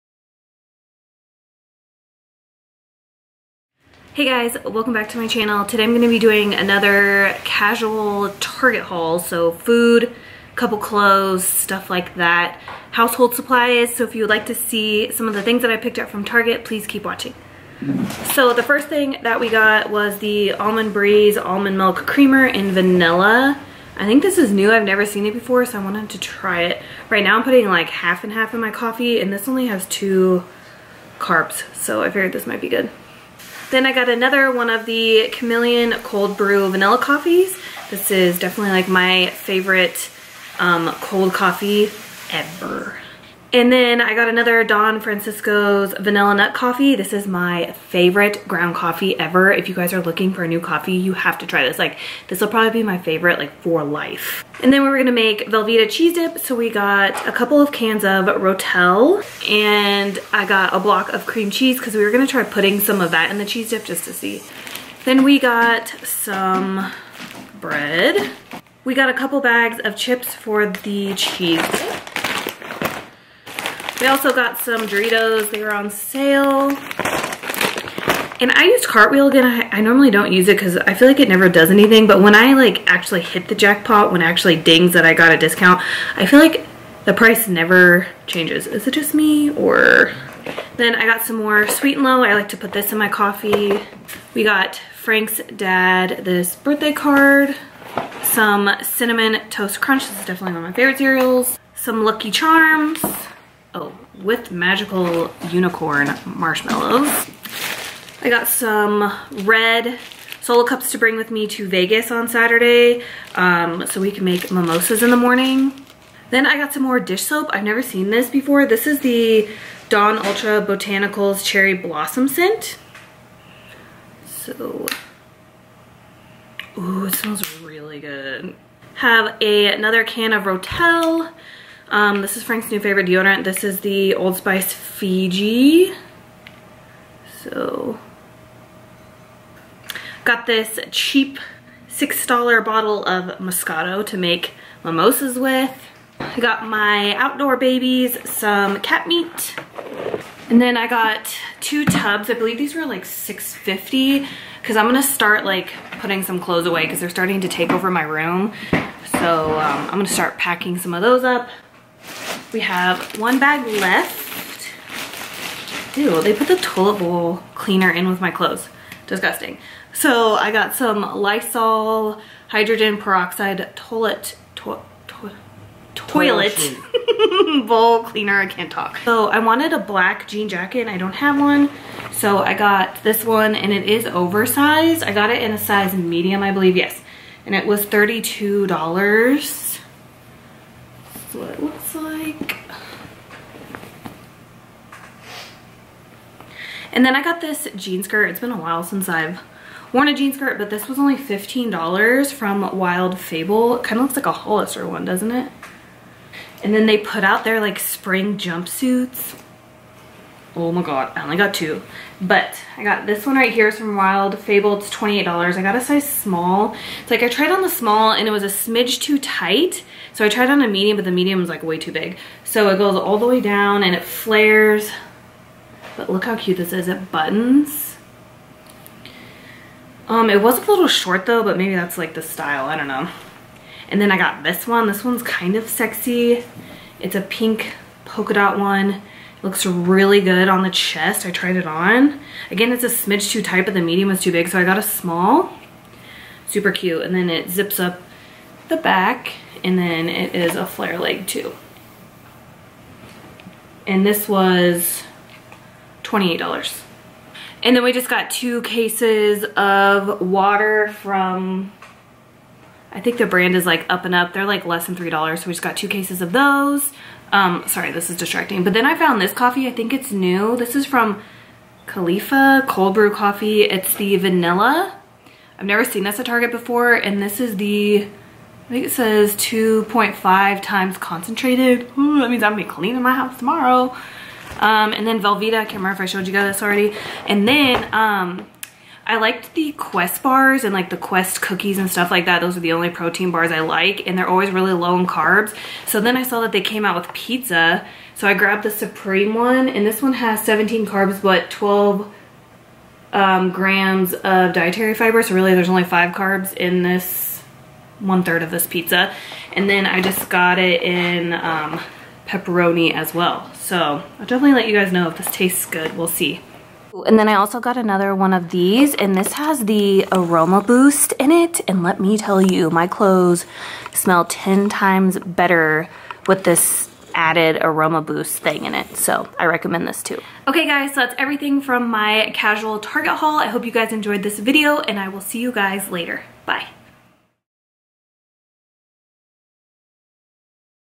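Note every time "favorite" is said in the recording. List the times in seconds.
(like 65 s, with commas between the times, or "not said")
39 s, 47 s, 52 s, 100 s, 132 s.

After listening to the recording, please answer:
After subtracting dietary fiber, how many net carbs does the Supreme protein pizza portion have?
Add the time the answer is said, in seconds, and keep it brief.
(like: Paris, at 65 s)
5, at 305 s.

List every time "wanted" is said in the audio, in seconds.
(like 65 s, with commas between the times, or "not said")
25 s, 179 s.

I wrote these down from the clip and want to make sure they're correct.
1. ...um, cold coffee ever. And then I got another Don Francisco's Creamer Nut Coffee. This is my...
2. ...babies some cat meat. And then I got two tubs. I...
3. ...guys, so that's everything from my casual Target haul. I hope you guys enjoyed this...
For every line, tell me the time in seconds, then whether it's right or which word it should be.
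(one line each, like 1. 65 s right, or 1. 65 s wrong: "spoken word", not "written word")
1. 40 s wrong: "Vanilla", not "Creamer"
2. 147 s right
3. 330 s right.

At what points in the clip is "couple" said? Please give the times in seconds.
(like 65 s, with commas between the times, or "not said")
10 s, 57 s, 69 s.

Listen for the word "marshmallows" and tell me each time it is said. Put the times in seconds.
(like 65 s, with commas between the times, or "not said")
106 s.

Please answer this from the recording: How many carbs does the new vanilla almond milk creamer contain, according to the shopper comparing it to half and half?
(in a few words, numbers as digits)
2.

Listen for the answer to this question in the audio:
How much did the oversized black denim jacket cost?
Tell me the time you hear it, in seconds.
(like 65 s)
187 s.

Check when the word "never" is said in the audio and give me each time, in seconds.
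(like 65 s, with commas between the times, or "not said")
24 s, 81 s, 87 s, 117 s, 275 s.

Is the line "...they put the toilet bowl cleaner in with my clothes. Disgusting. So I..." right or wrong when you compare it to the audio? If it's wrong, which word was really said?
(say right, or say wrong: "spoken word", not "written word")
right.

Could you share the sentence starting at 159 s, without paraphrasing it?
So um, I'm going to start packing some of those up.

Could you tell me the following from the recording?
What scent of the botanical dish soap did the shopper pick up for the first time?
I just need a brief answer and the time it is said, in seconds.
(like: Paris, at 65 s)
Cherry Blossom, at 121 s.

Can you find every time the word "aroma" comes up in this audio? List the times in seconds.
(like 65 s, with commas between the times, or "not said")
320 s, 327 s.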